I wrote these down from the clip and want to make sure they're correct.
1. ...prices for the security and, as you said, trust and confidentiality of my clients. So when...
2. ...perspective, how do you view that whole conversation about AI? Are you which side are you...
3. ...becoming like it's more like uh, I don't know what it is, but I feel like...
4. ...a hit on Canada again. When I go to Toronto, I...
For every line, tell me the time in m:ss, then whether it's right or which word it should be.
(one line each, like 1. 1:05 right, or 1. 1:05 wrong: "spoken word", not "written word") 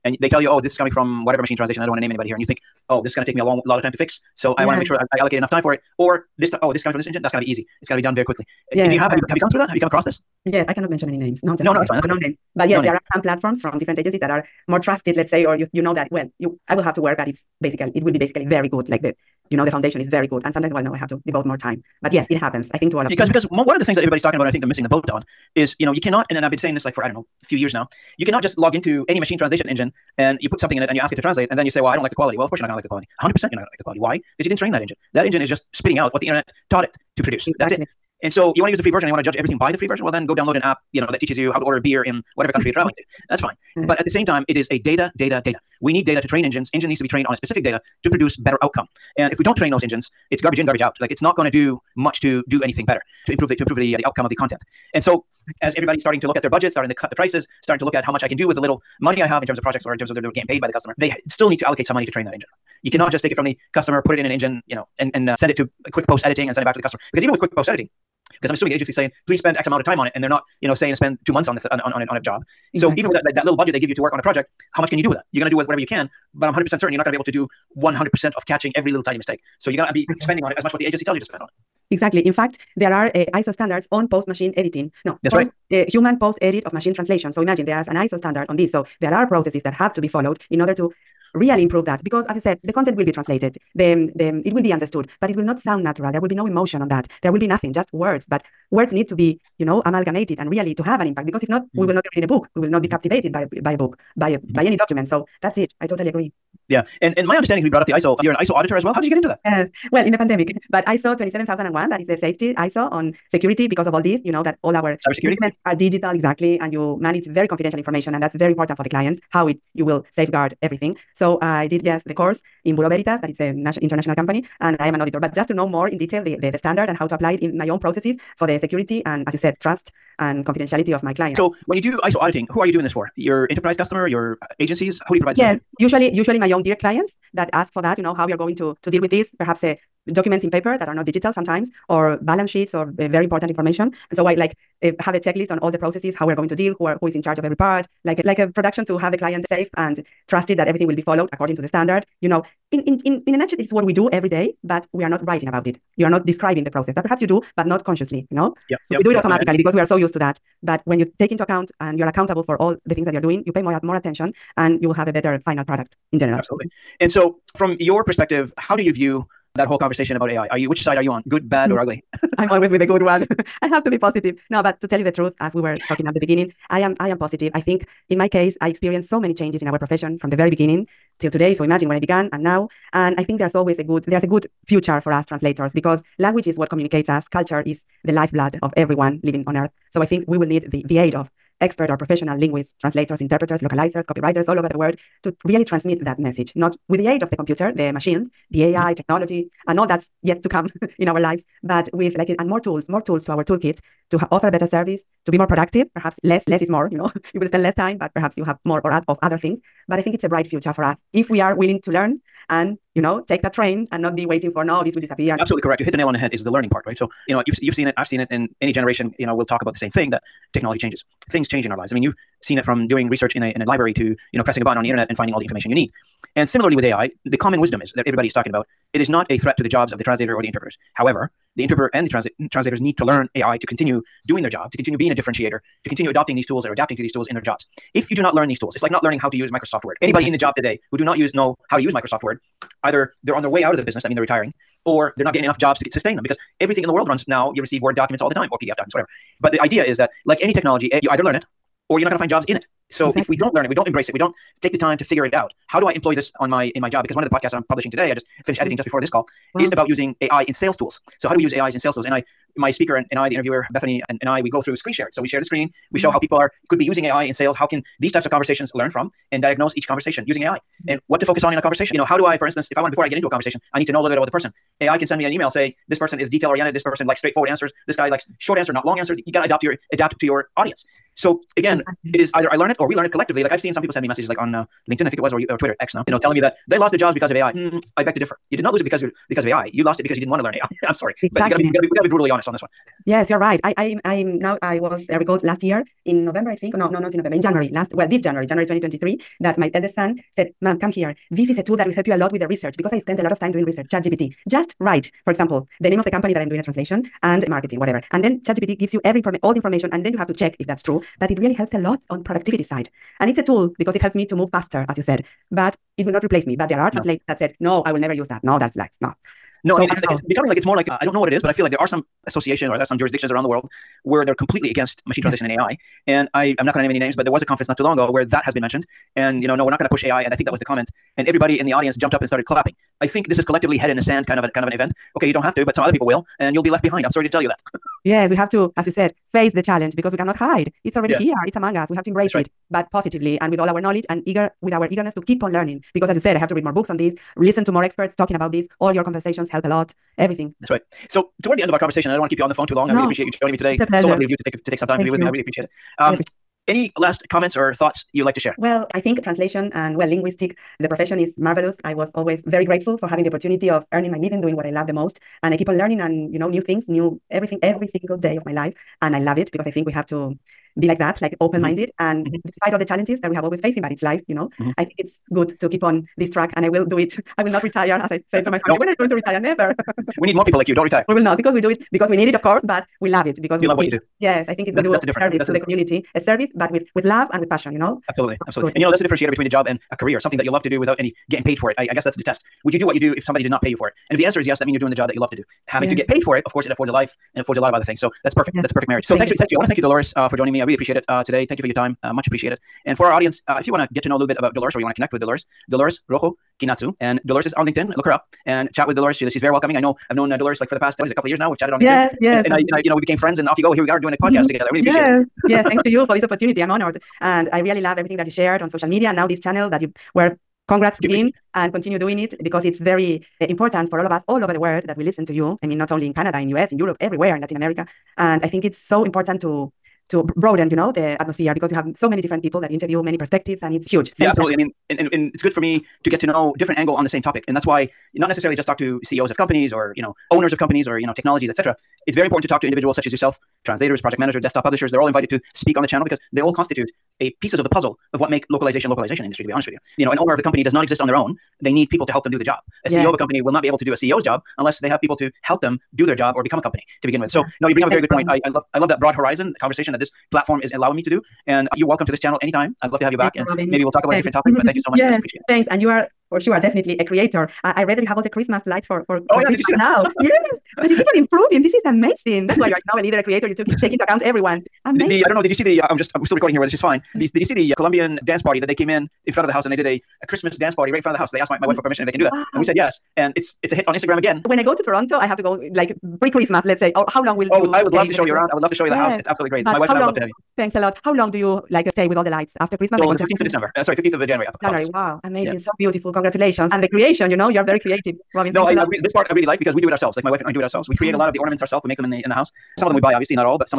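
1. 2:07 wrong: "processes", not "prices"
2. 2:48 right
3. 5:20 right
4. 8:03 wrong: "Instagram", not "Canada".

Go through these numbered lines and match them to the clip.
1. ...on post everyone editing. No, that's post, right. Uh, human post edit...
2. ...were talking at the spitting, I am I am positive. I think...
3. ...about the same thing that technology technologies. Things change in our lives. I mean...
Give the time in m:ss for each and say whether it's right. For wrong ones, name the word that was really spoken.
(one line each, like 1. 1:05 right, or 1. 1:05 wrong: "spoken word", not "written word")
1. 1:23 wrong: "machine", not "everyone"
2. 2:55 wrong: "beginning", not "spitting"
3. 3:39 wrong: "changes", not "technologies".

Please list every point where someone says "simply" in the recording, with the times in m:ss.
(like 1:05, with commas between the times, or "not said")
not said.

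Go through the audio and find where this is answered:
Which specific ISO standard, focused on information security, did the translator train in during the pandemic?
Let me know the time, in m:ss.
1:50.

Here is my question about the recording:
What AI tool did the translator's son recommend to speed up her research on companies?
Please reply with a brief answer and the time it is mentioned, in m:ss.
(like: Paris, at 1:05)
ChatGPT, at 5:03.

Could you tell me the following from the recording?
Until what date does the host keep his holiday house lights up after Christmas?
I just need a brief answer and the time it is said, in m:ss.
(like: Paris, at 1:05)
15 January, at 8:13.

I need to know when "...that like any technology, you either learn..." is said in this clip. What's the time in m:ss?
4:09.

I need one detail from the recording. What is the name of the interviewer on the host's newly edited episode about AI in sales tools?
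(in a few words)
Bethany.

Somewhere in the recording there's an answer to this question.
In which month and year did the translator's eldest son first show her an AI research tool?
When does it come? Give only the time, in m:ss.
4:58.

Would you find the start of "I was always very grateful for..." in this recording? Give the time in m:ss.
6:01.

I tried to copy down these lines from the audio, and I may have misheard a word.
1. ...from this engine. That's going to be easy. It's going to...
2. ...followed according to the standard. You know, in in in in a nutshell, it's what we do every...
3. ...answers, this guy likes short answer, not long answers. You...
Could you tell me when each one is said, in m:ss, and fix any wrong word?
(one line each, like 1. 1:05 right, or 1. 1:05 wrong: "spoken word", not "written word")
1. 0:06 right
2. 2:31 right
3. 4:37 right.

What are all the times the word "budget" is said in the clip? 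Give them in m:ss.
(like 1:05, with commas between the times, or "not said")
0:56, 1:13.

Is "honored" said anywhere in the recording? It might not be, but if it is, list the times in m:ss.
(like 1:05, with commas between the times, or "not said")
6:56.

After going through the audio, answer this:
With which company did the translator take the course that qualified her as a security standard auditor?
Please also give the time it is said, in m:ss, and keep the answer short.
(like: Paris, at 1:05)
Bureau Veritas, at 2:02.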